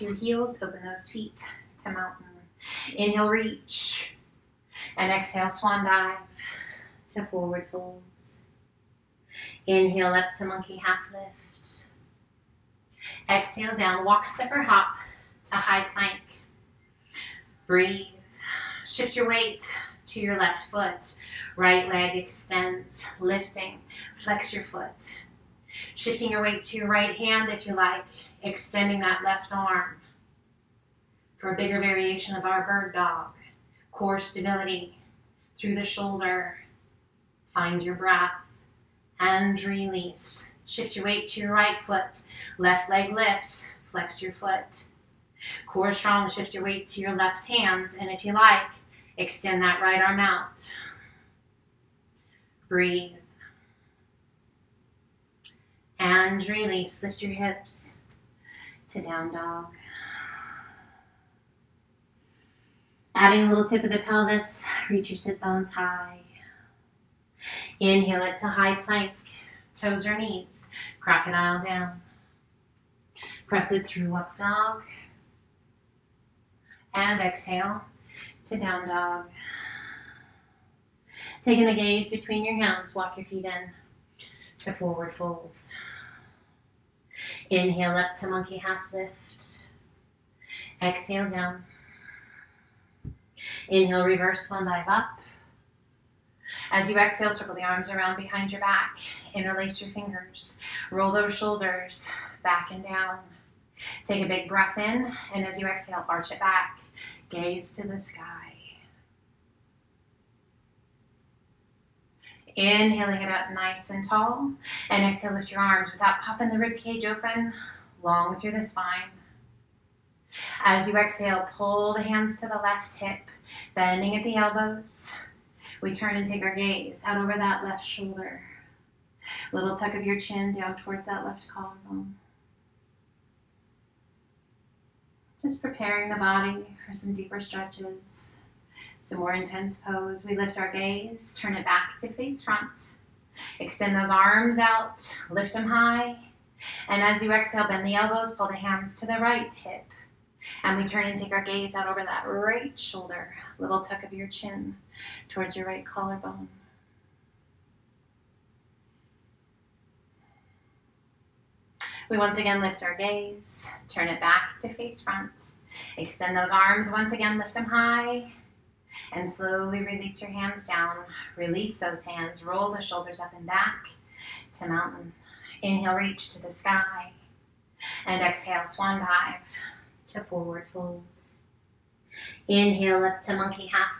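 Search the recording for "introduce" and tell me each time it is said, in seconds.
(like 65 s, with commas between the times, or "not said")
not said.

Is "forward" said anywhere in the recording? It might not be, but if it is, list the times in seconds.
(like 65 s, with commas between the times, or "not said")
7 s, 84 s, 180 s.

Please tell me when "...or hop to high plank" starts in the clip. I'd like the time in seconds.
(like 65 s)
14 s.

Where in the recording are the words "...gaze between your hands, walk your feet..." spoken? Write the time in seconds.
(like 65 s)
81 s.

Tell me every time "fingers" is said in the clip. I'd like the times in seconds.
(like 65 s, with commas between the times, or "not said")
99 s.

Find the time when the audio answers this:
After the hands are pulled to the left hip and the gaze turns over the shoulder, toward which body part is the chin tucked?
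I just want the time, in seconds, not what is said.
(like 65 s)
131 s.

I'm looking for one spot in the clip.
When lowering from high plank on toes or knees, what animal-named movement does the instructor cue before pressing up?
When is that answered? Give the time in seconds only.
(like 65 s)
70 s.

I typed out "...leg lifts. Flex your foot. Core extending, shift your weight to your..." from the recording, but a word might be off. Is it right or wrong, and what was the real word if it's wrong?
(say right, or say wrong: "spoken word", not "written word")
wrong: "strong", not "extending".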